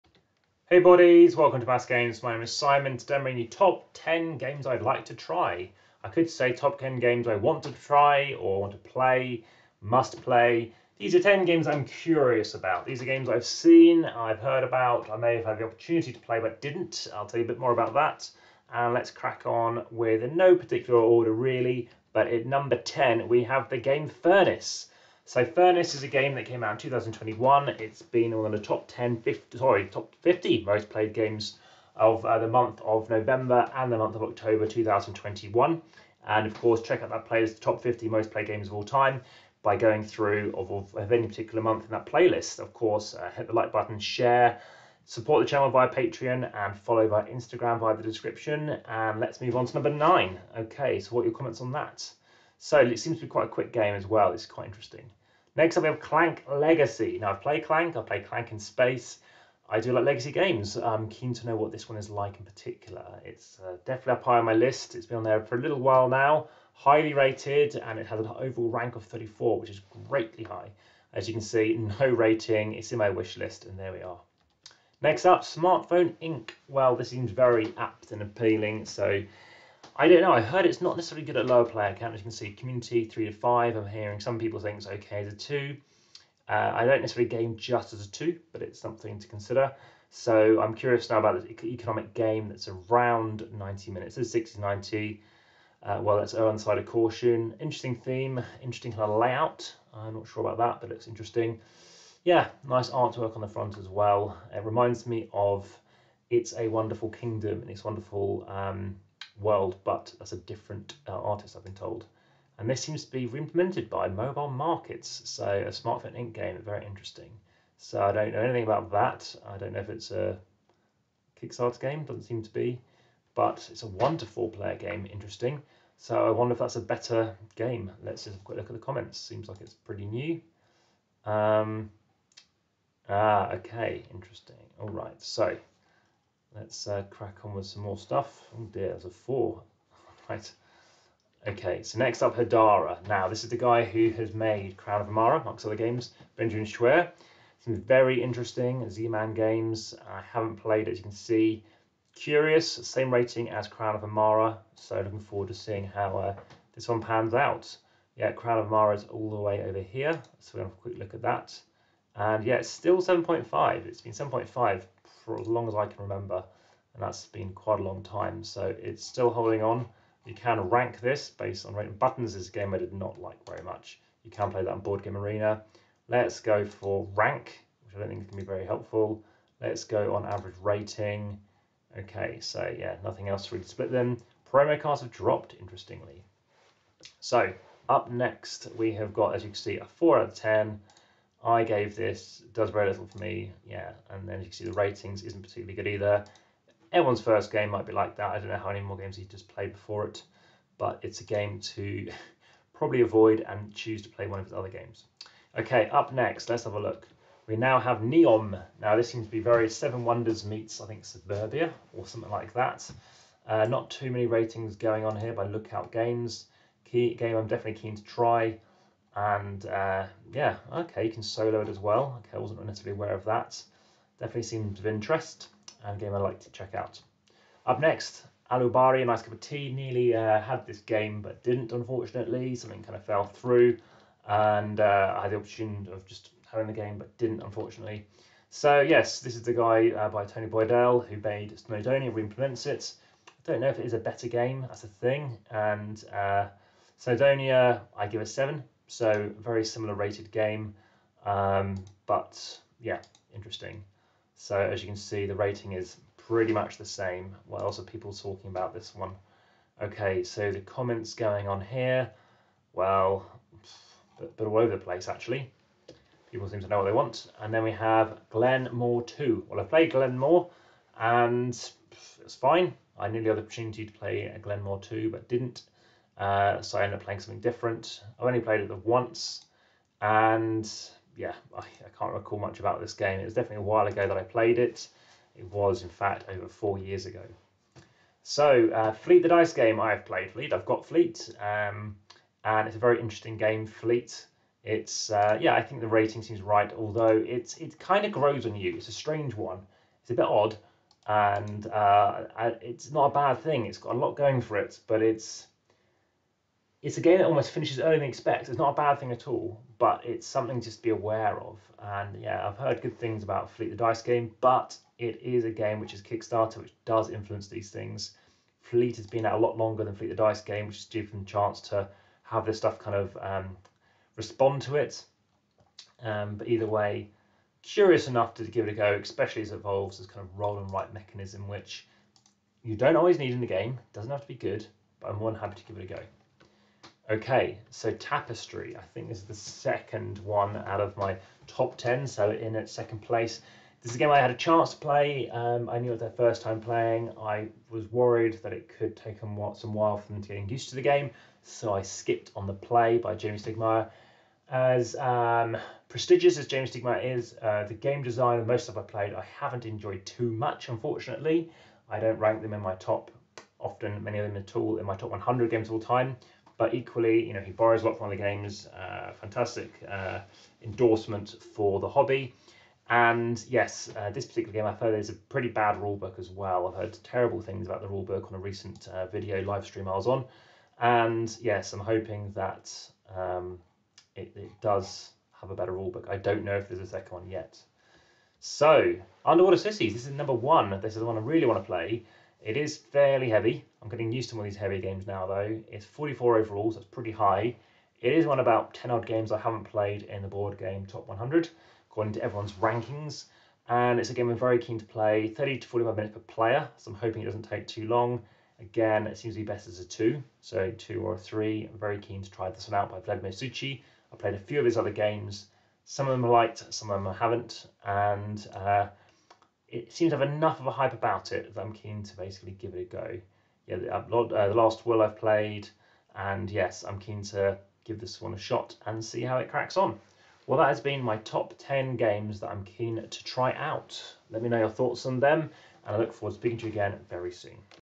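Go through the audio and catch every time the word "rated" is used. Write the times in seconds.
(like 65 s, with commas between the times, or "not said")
67 s, 249 s.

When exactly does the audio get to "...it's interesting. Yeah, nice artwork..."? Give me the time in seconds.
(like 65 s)
100 s.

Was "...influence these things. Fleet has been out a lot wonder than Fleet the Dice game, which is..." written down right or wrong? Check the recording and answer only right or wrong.
wrong.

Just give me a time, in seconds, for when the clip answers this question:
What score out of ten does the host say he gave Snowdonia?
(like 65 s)
248 s.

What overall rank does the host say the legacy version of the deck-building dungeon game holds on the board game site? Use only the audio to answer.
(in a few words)
34.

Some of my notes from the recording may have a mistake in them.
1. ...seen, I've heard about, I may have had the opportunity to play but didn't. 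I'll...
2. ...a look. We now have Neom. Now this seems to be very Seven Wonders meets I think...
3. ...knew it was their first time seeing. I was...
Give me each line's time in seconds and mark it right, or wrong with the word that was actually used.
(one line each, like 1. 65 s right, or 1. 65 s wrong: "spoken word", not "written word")
1. 13 s right
2. 206 s right
3. 345 s wrong: "playing", not "seeing".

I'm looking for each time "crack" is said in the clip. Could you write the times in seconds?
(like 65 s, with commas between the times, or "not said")
19 s, 137 s, 429 s.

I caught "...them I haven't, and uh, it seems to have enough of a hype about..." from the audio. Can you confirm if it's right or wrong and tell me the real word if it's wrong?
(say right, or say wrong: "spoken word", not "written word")
right.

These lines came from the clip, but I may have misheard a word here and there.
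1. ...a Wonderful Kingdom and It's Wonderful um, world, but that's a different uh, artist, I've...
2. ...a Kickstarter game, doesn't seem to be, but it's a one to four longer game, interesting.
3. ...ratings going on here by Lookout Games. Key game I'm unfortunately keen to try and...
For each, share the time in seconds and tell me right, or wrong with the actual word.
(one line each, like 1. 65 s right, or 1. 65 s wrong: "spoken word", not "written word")
1. 106 s right
2. 120 s wrong: "player", not "longer"
3. 214 s wrong: "definitely", not "unfortunately".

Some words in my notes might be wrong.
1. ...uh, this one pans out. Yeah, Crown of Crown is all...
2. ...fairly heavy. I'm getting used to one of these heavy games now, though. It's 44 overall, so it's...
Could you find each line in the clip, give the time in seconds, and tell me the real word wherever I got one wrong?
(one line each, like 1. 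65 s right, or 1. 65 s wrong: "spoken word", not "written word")
1. 156 s wrong: "Emara", not "Crown"
2. 392 s right.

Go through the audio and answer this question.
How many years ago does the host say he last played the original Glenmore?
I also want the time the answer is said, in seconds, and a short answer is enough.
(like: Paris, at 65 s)
over four years, at 286 s.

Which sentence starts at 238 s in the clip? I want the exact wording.
So, yes, this is the guy uh, by Tony Boydell who made Snowdonia, reimplements it.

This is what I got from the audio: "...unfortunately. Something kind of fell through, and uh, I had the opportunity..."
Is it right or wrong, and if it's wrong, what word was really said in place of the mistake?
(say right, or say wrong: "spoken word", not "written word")
right.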